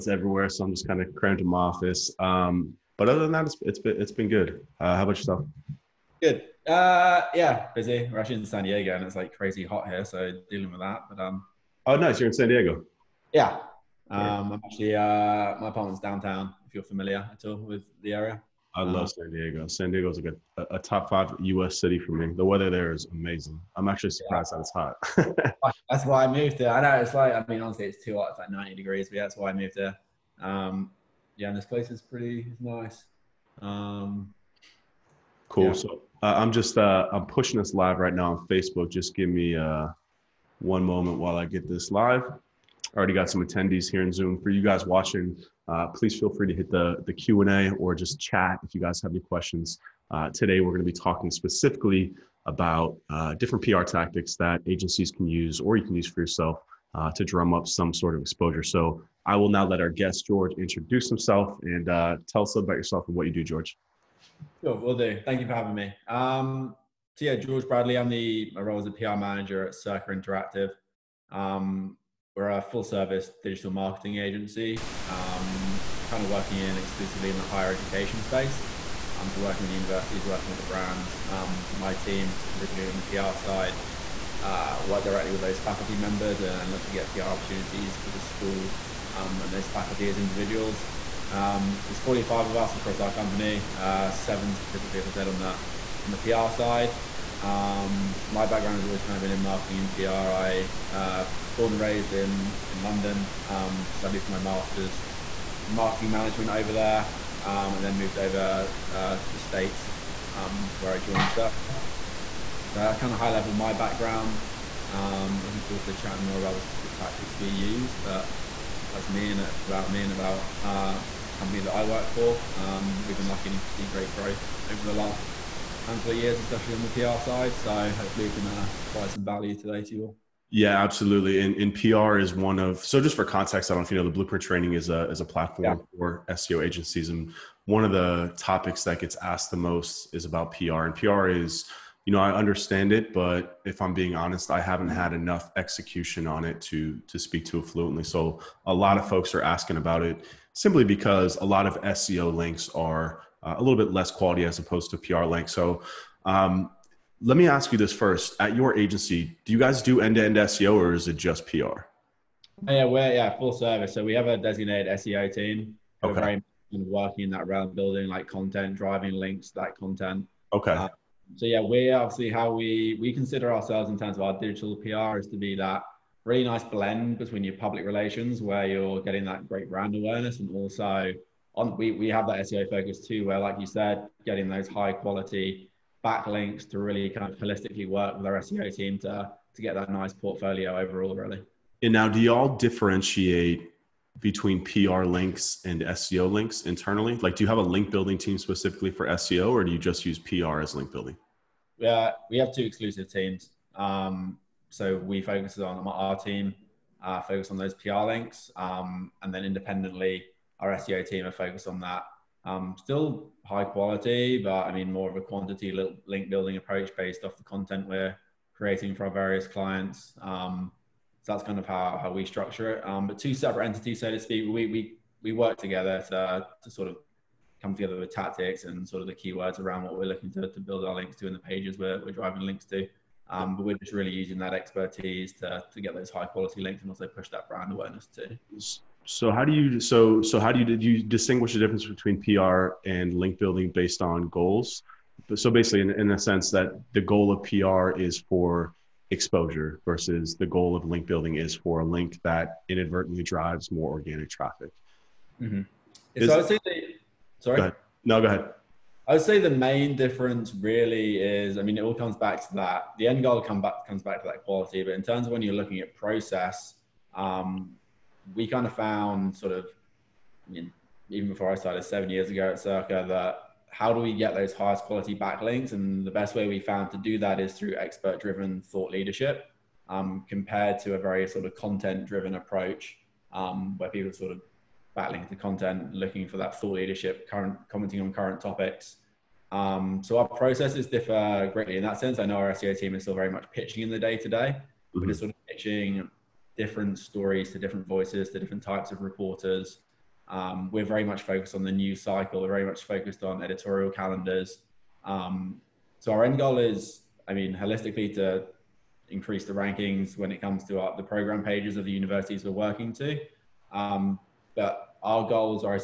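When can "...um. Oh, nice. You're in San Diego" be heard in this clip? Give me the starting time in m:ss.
0:11.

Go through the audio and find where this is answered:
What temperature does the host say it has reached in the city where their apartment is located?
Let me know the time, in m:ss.
0:28.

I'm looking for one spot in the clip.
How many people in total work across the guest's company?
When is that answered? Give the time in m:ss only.
1:31.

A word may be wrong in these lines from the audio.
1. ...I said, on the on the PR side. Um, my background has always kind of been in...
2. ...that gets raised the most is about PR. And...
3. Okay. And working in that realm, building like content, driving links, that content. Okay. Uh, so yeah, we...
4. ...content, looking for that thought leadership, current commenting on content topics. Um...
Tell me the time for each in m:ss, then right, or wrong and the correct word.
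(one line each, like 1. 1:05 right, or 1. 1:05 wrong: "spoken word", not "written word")
1. 1:35 right
2. 2:18 wrong: "asked", not "raised"
3. 2:46 right
4. 4:45 wrong: "current", not "content".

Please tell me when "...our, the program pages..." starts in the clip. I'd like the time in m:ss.
5:10.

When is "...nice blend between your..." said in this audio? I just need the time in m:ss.
2:56.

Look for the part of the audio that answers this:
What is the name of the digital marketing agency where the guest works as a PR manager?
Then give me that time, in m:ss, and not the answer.
1:09.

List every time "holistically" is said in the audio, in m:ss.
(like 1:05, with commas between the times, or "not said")
3:07, 5:07.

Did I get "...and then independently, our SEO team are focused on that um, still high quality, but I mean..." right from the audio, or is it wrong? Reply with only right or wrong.
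right.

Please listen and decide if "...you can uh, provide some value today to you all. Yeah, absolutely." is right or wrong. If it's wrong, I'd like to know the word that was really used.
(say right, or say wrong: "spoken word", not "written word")
right.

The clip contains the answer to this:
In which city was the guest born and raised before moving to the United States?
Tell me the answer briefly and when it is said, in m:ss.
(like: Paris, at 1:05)
London, at 1:42.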